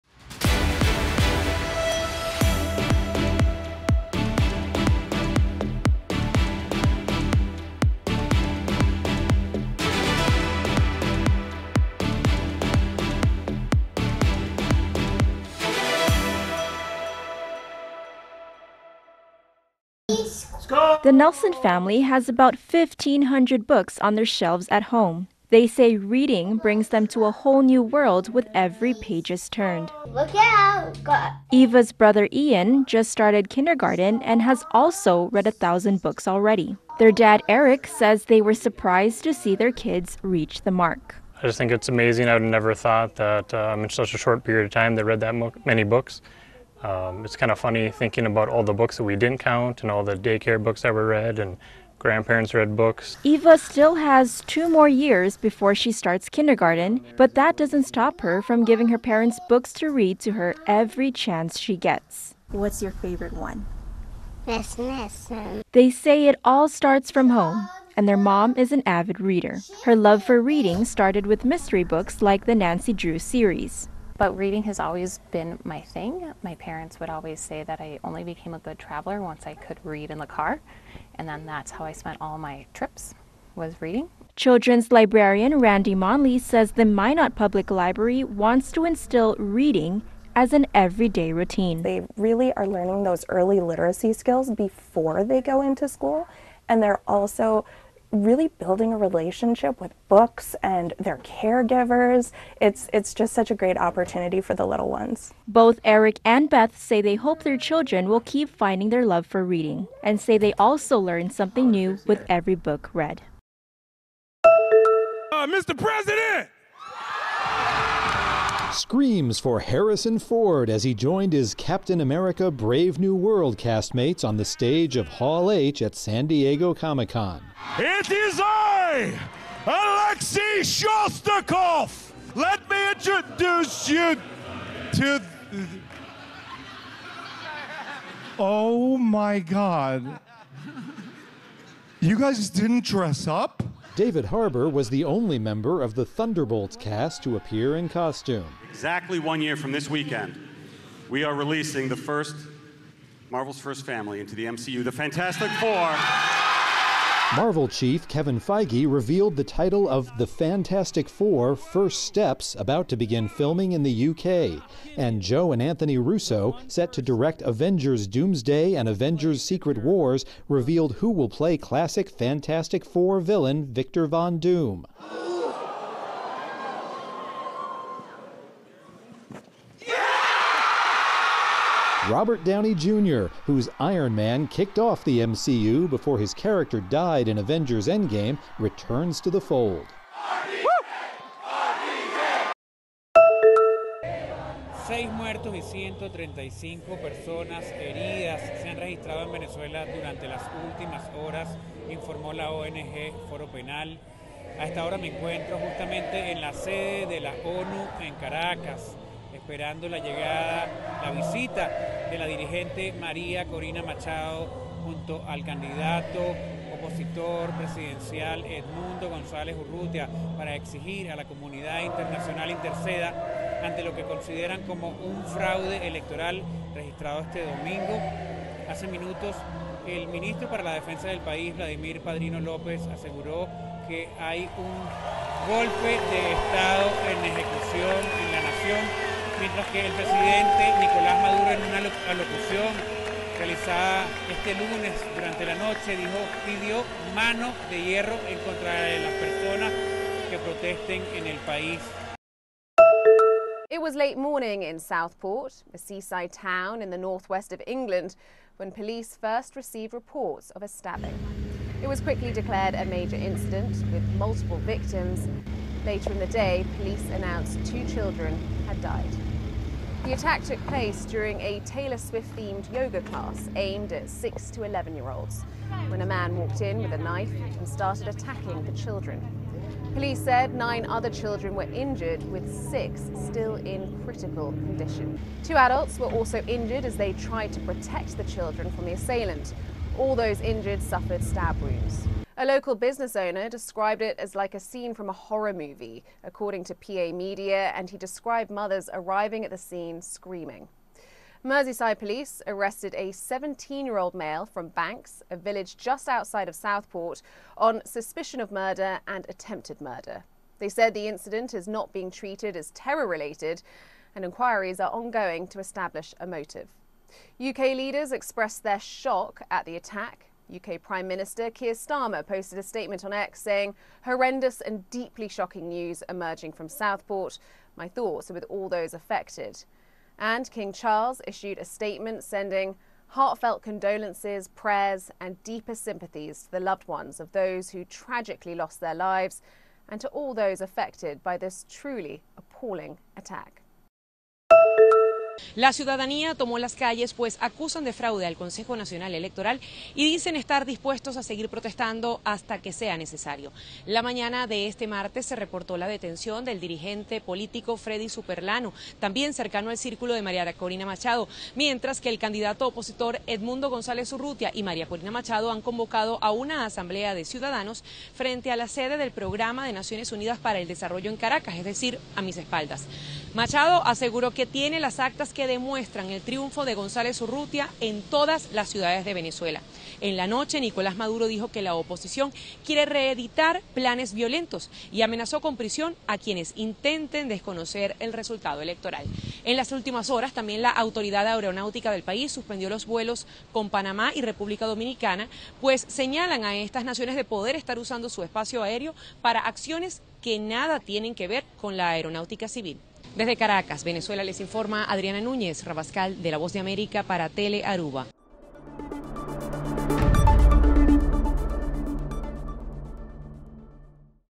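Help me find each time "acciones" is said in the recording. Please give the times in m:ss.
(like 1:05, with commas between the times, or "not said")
6:39.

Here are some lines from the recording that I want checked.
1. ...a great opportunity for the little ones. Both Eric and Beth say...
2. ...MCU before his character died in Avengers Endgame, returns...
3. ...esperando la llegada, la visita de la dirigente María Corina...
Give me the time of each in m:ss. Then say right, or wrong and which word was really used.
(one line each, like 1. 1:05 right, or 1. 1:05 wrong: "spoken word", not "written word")
1. 1:43 right
2. 3:05 right
3. 3:29 right.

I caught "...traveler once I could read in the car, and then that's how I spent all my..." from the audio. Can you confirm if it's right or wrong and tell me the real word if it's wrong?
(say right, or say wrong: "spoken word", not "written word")
right.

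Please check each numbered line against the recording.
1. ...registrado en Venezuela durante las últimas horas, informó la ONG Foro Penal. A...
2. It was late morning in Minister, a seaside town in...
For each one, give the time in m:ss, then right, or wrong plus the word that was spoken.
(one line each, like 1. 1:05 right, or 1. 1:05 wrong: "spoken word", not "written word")
1. 3:18 right
2. 4:13 wrong: "Southport", not "Minister".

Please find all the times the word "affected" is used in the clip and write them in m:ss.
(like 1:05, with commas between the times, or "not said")
5:28, 5:40.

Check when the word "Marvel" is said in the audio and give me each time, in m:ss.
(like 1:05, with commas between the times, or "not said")
2:33, 2:37.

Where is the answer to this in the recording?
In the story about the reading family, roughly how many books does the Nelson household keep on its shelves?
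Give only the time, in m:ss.
0:22.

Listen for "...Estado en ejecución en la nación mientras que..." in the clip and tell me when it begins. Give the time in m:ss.
3:56.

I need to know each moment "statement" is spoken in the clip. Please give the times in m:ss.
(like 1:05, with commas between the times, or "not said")
5:22, 5:31.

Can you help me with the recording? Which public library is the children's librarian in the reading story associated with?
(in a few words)
Minot Public Library.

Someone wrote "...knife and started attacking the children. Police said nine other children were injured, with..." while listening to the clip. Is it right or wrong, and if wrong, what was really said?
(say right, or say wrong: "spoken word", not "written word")
right.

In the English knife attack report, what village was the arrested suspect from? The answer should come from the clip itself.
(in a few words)
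Banks.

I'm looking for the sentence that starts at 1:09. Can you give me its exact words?
Her love for reading started with mystery books like the Nancy Drew series.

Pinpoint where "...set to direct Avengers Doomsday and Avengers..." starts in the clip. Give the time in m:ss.
2:46.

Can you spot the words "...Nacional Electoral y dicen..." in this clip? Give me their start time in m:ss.
5:48.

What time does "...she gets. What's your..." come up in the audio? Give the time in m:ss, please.
1:01.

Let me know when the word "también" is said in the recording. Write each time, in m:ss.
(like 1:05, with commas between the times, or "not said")
5:58, 6:30.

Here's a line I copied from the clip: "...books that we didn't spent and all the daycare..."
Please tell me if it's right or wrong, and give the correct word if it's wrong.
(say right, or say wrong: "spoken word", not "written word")
wrong: "count", not "spent".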